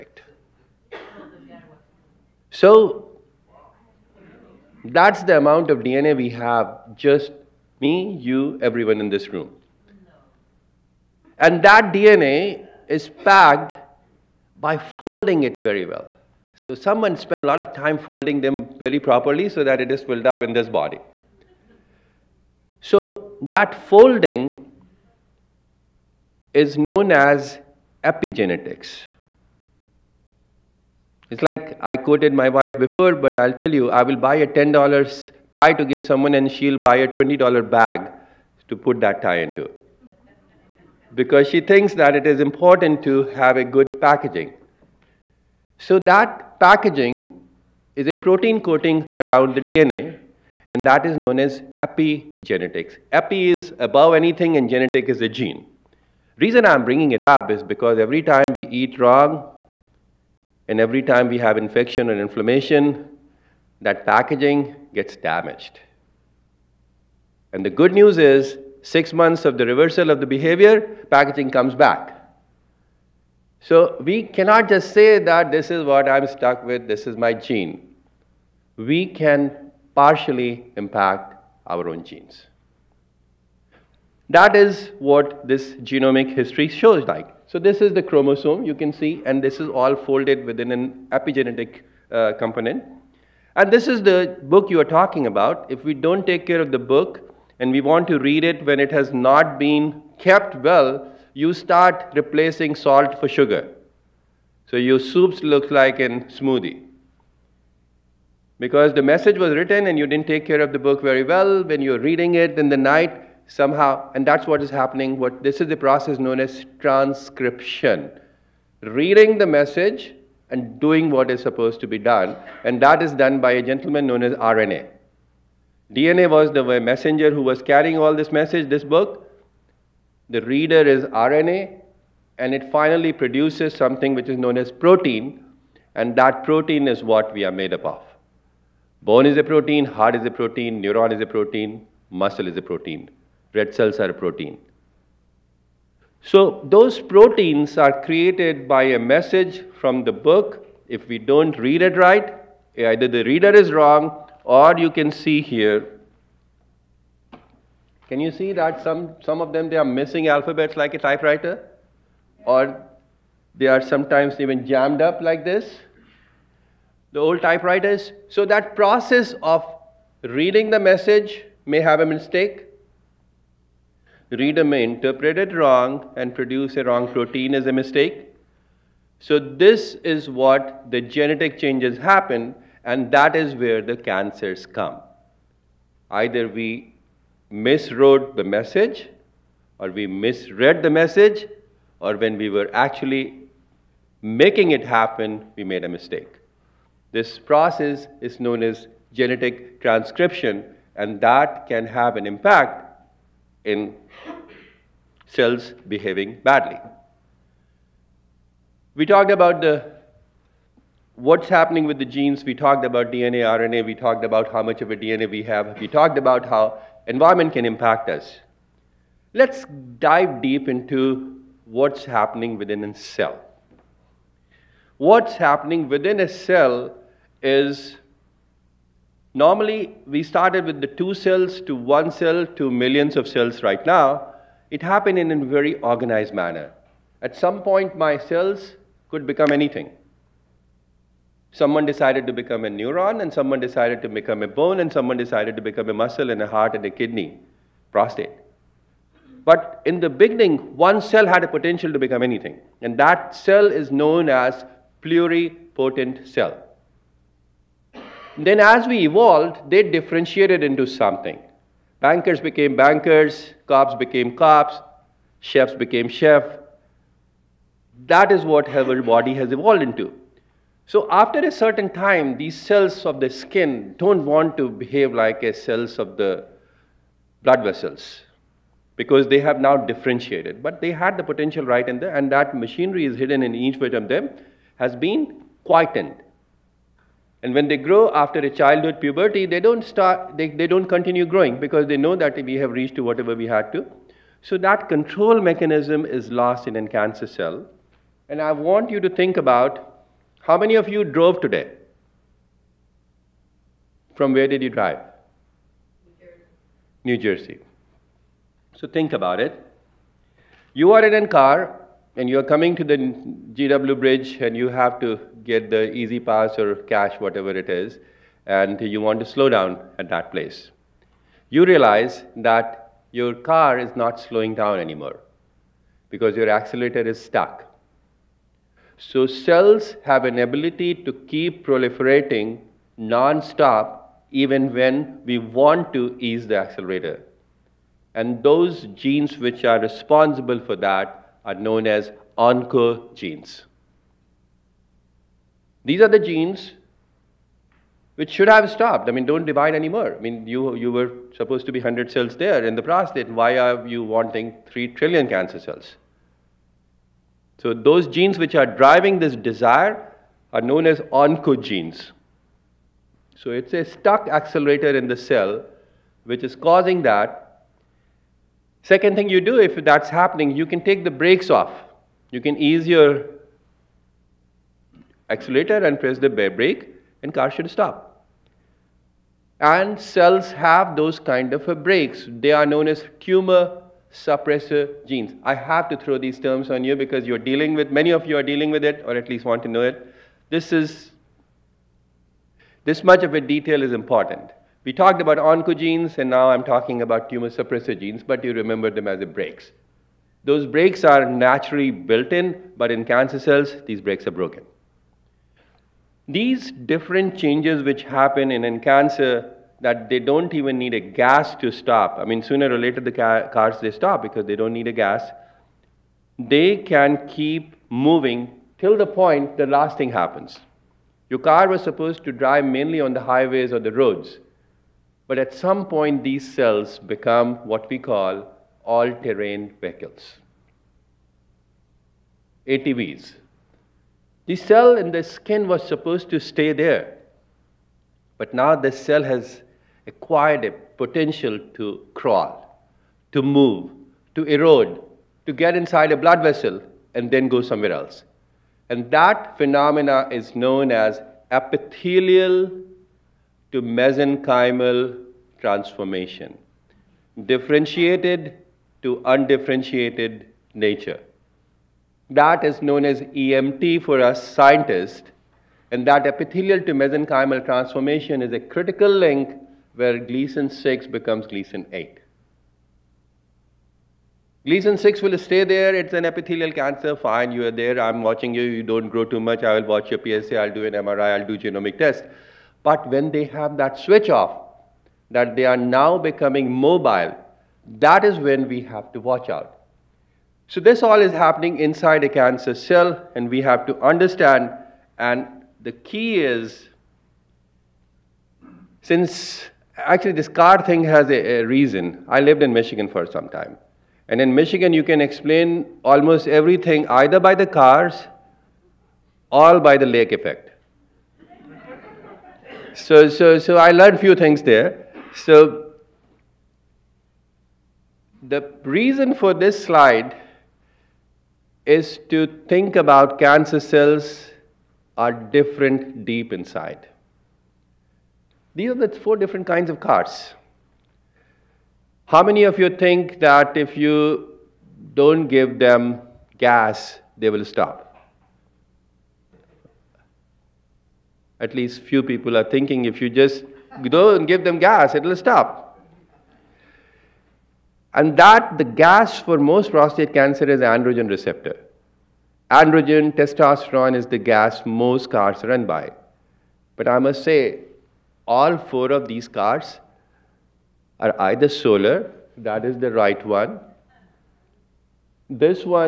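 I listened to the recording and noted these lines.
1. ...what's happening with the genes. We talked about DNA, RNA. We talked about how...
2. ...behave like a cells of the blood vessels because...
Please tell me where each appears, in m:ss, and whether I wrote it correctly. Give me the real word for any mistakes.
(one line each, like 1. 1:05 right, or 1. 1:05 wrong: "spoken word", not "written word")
1. 3:31 right
2. 4:34 right.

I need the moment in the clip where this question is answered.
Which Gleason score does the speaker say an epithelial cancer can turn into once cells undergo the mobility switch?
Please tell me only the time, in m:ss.
7:51.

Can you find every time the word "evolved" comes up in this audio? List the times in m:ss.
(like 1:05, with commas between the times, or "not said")
4:19, 4:29.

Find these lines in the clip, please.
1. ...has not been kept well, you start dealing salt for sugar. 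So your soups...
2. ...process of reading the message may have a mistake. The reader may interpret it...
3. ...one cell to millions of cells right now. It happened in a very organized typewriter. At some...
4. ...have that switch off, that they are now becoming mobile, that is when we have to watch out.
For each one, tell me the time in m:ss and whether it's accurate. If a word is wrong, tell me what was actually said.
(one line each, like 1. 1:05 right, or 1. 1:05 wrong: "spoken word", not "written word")
1. 1:38 wrong: "replacing", not "dealing"
2. 2:48 right
3. 3:51 wrong: "manner", not "typewriter"
4. 8:03 right.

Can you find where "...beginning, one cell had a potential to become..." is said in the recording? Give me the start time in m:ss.
4:10.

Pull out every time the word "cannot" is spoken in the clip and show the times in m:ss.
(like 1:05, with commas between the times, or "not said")
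1:14.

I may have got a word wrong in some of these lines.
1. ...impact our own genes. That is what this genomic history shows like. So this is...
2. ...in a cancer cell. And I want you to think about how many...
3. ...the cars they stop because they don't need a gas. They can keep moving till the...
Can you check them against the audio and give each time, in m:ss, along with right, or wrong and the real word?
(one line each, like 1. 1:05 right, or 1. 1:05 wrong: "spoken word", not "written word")
1. 1:20 right
2. 4:56 right
3. 6:53 right.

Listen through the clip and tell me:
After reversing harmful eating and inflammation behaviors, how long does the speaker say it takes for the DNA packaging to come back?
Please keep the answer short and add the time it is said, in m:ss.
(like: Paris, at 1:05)
six months, at 1:08.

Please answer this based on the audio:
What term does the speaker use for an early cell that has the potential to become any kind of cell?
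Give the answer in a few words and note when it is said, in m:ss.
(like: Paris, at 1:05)
pluripotent cell, at 4:15.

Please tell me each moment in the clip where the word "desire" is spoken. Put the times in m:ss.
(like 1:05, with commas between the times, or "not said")
5:59.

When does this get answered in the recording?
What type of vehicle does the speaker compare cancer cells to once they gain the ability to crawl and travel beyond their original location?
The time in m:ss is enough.
7:12.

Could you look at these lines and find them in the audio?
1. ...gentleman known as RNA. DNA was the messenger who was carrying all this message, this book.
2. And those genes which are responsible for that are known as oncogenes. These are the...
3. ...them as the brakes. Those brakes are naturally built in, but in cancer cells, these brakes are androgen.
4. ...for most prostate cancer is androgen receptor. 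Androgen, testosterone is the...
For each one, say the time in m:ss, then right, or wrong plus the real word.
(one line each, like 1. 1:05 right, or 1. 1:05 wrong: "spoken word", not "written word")
1. 2:03 right
2. 5:38 right
3. 6:38 wrong: "broken", not "androgen"
4. 9:09 right.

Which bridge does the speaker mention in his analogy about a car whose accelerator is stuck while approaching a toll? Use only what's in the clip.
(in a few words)
GW bridge.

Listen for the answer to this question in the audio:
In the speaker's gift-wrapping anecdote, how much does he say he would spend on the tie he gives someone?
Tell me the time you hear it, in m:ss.
0:34.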